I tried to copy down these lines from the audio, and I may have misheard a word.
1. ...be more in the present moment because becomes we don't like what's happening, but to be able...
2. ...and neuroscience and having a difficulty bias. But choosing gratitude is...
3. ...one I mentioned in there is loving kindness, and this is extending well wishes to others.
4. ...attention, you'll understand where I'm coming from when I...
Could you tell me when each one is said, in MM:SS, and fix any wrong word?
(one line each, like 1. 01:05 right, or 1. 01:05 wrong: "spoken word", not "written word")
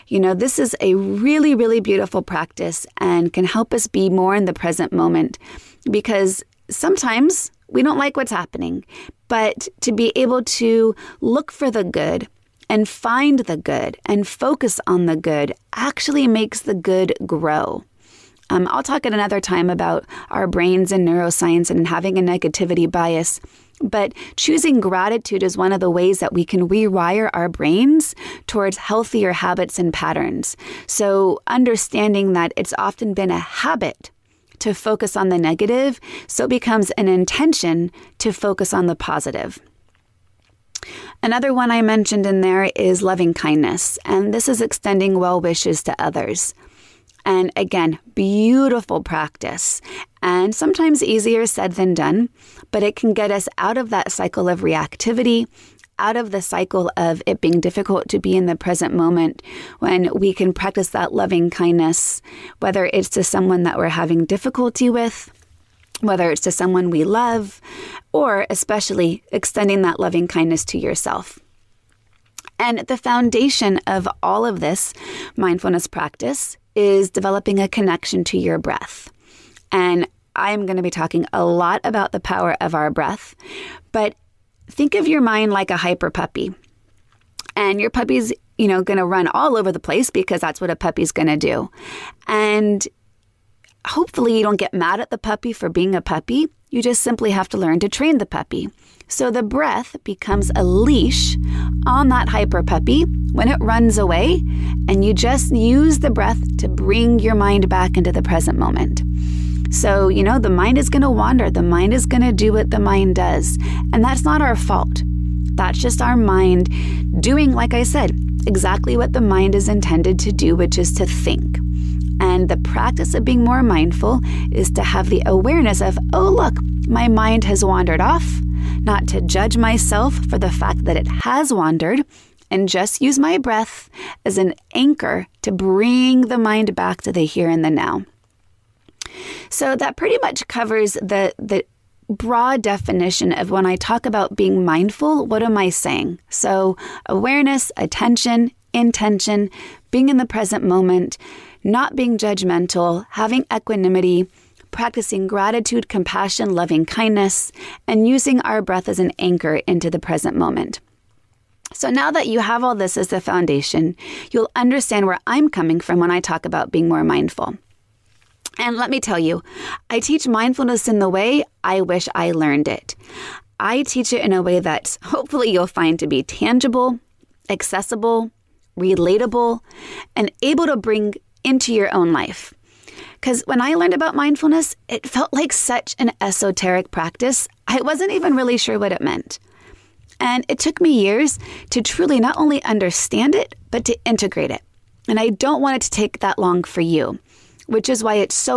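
1. 00:03 wrong: "sometimes", not "becomes"
2. 00:20 wrong: "negativity", not "difficulty"
3. 00:41 right
4. 02:43 wrong: "foundation", not "attention".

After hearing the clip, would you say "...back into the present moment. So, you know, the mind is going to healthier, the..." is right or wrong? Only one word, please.
wrong.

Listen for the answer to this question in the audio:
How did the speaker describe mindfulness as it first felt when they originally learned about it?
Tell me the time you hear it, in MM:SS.
03:06.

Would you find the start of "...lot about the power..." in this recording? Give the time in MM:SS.
01:21.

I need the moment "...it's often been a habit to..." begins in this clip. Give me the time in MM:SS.
00:32.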